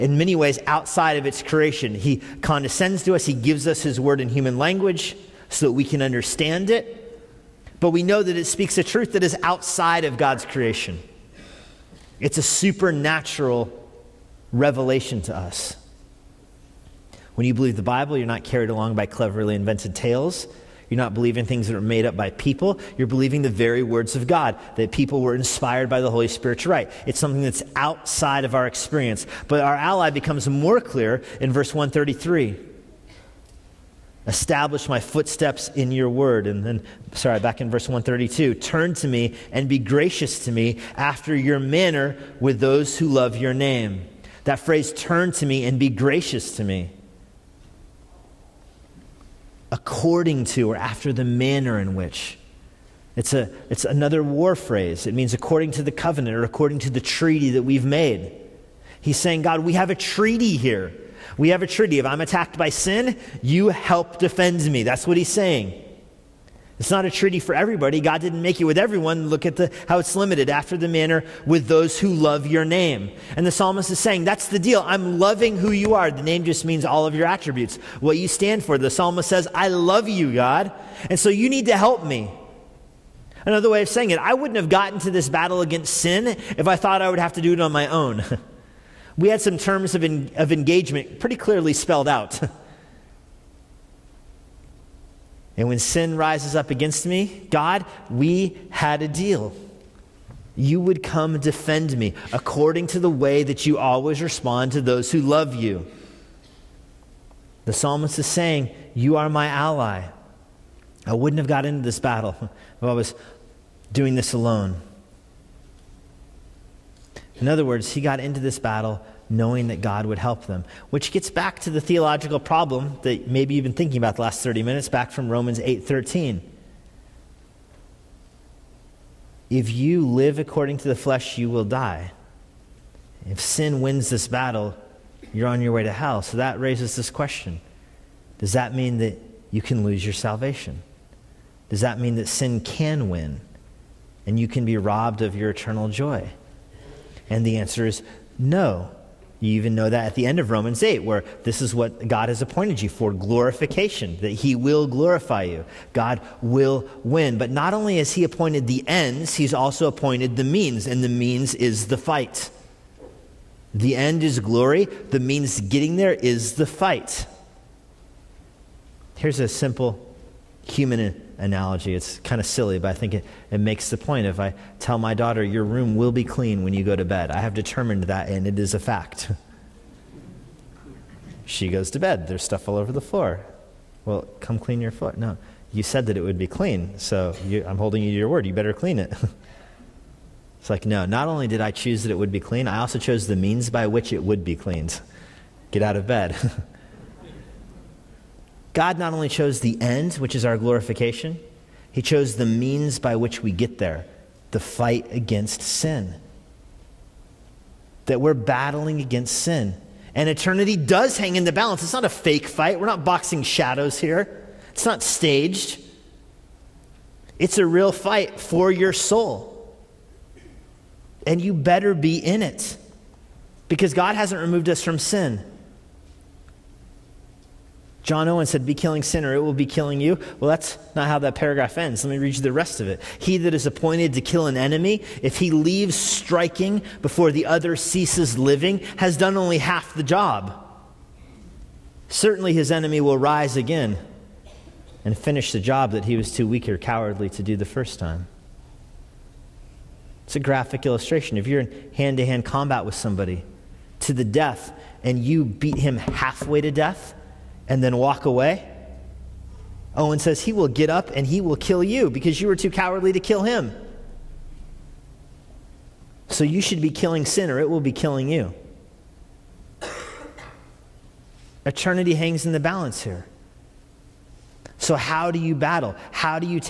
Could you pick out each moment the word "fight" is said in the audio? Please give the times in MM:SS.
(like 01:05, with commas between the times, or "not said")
02:41, 02:46, 03:24, 03:32, 03:37.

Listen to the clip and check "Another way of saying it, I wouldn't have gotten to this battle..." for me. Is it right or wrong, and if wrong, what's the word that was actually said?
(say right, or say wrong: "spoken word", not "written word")
right.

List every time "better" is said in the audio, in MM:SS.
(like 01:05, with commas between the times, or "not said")
03:08, 03:41.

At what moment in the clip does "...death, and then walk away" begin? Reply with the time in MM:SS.
04:16.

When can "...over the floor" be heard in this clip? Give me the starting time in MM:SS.
03:02.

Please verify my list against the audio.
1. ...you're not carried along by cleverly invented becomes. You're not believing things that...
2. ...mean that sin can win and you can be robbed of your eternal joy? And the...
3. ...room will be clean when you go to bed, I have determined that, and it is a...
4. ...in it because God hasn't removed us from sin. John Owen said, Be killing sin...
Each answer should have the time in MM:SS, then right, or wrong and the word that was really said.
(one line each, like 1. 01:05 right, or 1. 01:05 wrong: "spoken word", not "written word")
1. 00:18 wrong: "tales", not "becomes"
2. 02:21 right
3. 02:55 right
4. 03:42 right.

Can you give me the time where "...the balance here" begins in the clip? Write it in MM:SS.
04:32.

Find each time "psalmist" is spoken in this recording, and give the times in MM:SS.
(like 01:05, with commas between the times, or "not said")
01:13, 01:18, 01:47.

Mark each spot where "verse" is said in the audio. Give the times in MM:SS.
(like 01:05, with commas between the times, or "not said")
00:31, 00:37.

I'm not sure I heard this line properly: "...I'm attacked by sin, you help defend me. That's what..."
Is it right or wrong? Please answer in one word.
right.